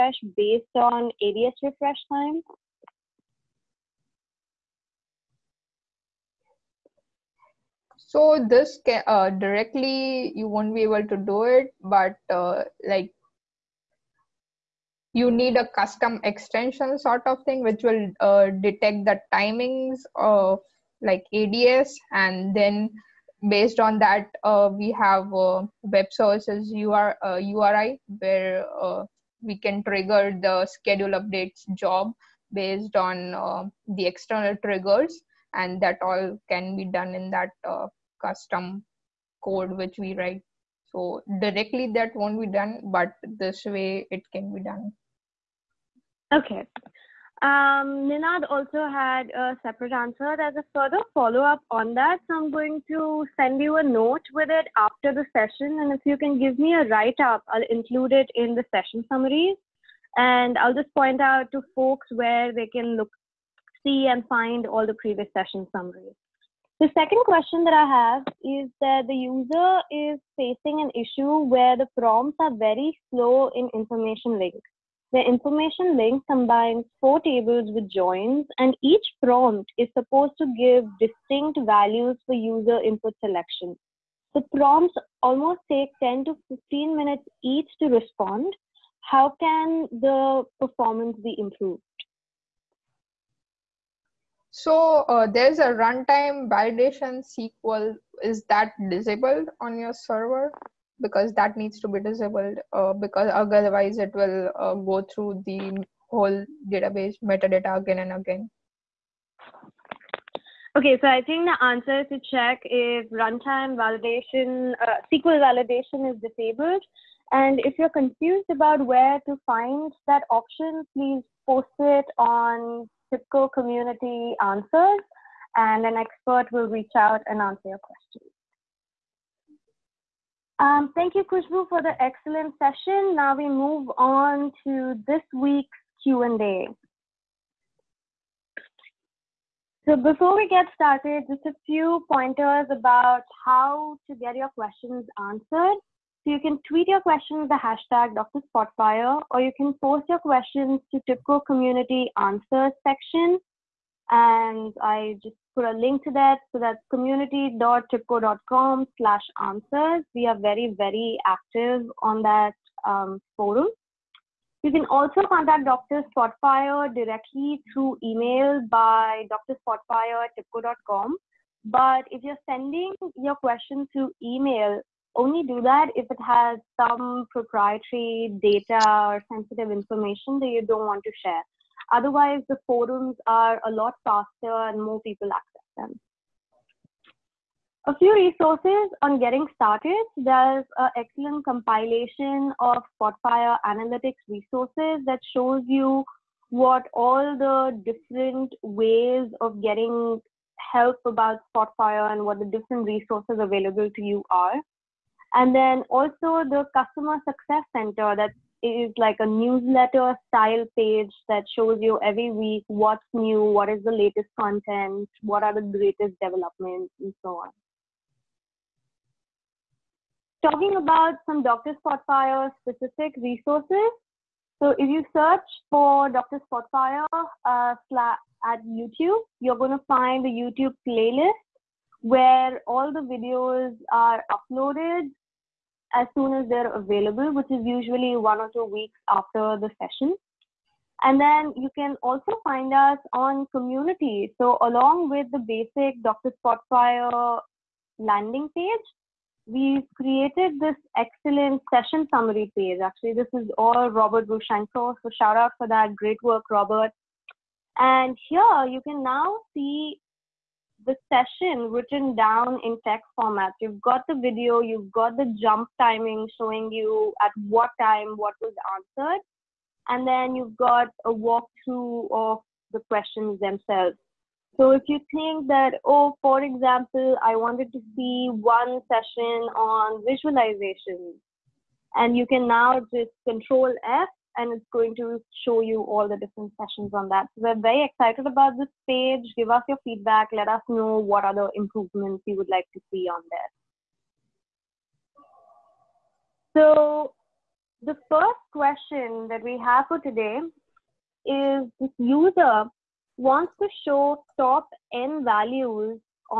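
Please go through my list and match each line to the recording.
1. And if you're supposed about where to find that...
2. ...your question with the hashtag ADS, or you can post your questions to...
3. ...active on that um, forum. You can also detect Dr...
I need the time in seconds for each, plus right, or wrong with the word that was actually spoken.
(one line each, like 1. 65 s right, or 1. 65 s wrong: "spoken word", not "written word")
1. 117 s wrong: "confused", not "supposed"
2. 146 s wrong: "DrSpotfire", not "ADS"
3. 161 s wrong: "contact", not "detect".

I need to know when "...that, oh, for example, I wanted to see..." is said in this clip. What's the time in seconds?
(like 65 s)
275 s.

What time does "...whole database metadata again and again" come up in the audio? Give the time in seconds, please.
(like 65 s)
106 s.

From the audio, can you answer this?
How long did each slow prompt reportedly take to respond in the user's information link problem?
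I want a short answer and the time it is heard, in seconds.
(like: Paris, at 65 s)
10 to 15 minutes, at 86 s.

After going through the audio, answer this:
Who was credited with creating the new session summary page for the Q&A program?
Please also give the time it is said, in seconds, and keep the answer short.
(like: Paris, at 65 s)
Robert Rushenko, at 253 s.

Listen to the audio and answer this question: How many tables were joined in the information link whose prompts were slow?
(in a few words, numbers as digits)
4.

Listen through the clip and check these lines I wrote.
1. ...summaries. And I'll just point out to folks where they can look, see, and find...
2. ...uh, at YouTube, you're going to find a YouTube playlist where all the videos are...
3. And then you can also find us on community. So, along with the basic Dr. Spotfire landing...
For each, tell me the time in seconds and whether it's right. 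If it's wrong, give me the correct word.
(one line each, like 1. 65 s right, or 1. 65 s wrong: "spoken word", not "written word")
1. 59 s right
2. 227 s right
3. 241 s right.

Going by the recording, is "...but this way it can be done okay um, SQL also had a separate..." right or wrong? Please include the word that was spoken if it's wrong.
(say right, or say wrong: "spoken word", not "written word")
wrong: "Ninad", not "SQL".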